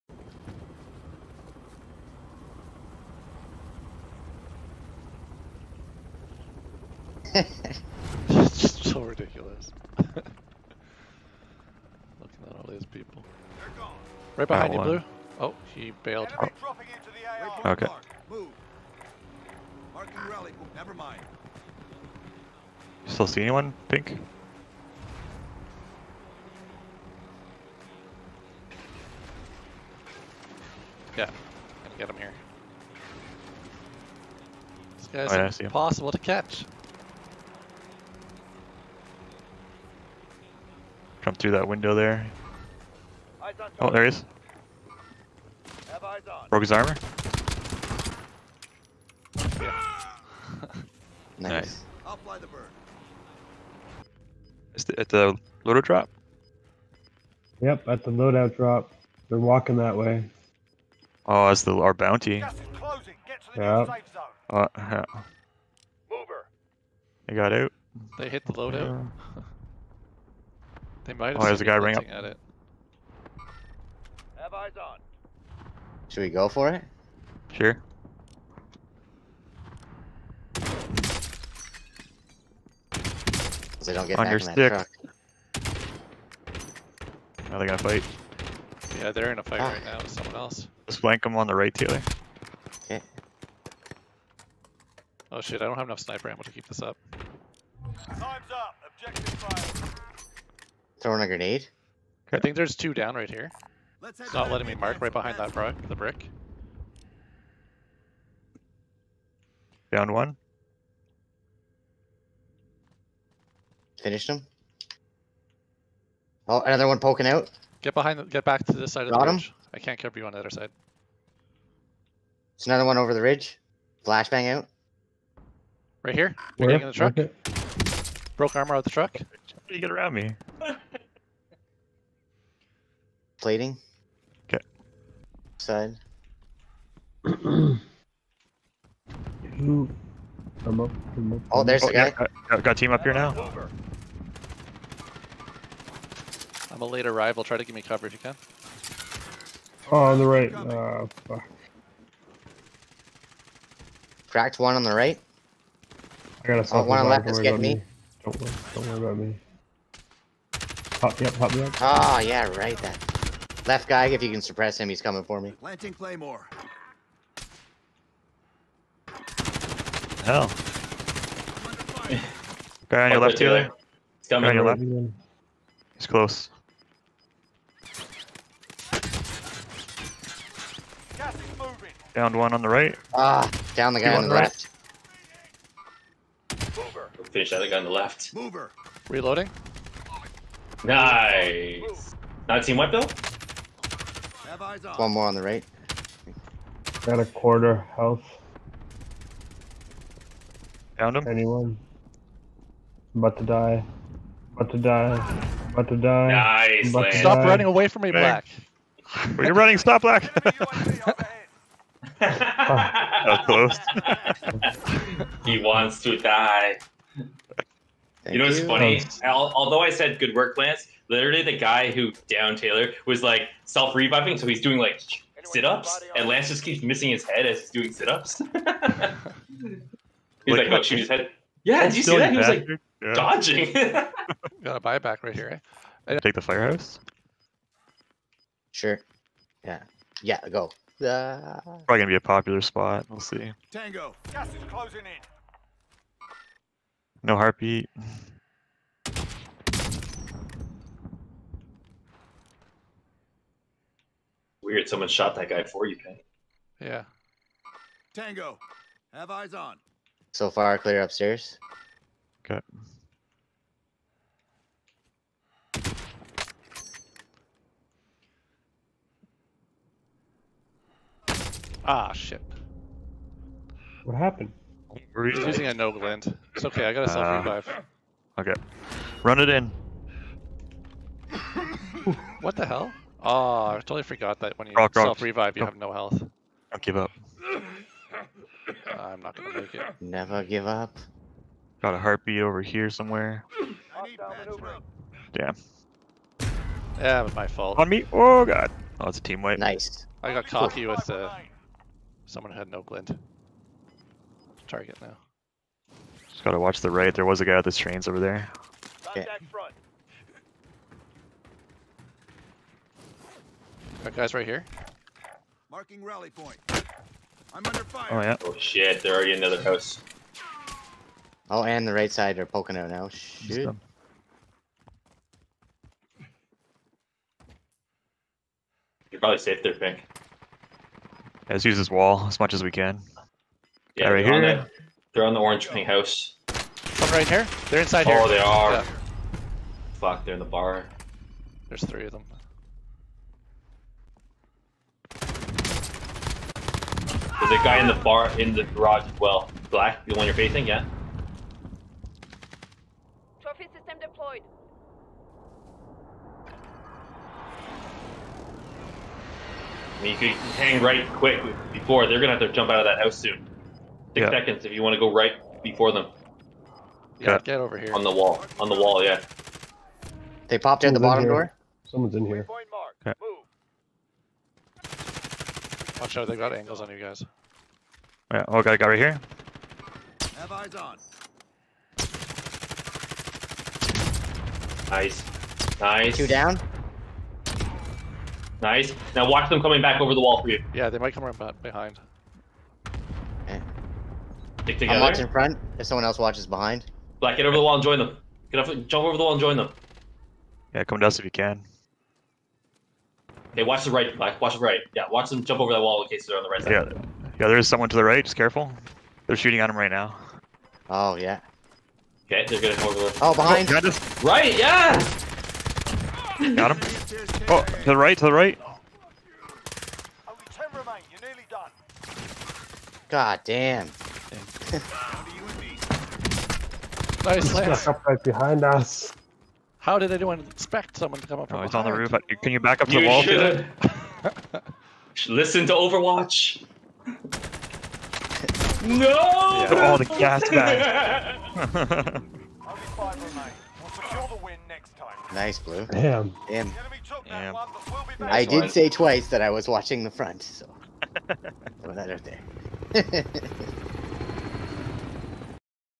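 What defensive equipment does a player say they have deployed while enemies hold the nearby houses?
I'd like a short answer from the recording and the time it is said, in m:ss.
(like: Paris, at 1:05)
Trophy system, at 5:53.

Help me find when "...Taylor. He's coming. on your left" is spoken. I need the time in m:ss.
2:53.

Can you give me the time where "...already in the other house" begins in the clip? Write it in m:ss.
5:19.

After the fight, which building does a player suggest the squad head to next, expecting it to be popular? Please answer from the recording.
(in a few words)
the firehouse.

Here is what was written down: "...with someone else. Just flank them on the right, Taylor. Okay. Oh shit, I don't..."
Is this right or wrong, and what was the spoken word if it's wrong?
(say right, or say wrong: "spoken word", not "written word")
right.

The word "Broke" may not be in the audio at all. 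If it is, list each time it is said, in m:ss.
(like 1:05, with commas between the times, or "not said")
0:46, 2:08.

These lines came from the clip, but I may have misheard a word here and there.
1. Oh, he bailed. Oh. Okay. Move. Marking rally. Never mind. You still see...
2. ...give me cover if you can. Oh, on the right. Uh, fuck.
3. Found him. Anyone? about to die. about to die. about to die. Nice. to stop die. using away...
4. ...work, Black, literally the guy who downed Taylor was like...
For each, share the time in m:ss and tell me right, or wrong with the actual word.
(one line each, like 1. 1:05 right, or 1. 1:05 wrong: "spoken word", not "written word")
1. 0:15 right
2. 2:27 right
3. 3:20 wrong: "running", not "using"
4. 3:40 wrong: "Lance", not "Black".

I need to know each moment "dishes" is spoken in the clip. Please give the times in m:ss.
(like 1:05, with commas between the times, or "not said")
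not said.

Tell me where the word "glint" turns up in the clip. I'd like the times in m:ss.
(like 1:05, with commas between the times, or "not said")
4:35, 5:02.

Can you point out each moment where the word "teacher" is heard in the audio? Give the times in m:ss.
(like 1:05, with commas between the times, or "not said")
not said.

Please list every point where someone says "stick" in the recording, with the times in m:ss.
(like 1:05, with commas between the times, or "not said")
1:24, 6:34.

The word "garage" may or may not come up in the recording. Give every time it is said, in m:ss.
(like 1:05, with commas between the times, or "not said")
5:48.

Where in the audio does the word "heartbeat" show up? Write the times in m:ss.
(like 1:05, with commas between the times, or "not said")
4:07, 4:51.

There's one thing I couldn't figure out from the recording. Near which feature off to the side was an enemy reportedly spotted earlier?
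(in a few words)
the trains.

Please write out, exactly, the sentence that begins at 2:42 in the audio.
That left guy, if you can suppress him, he's coming for me.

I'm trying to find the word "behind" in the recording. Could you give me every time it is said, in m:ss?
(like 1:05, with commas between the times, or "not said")
0:14, 1:45, 1:57, 6:31, 6:36, 6:53, 7:08.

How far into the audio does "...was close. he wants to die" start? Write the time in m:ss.
3:33.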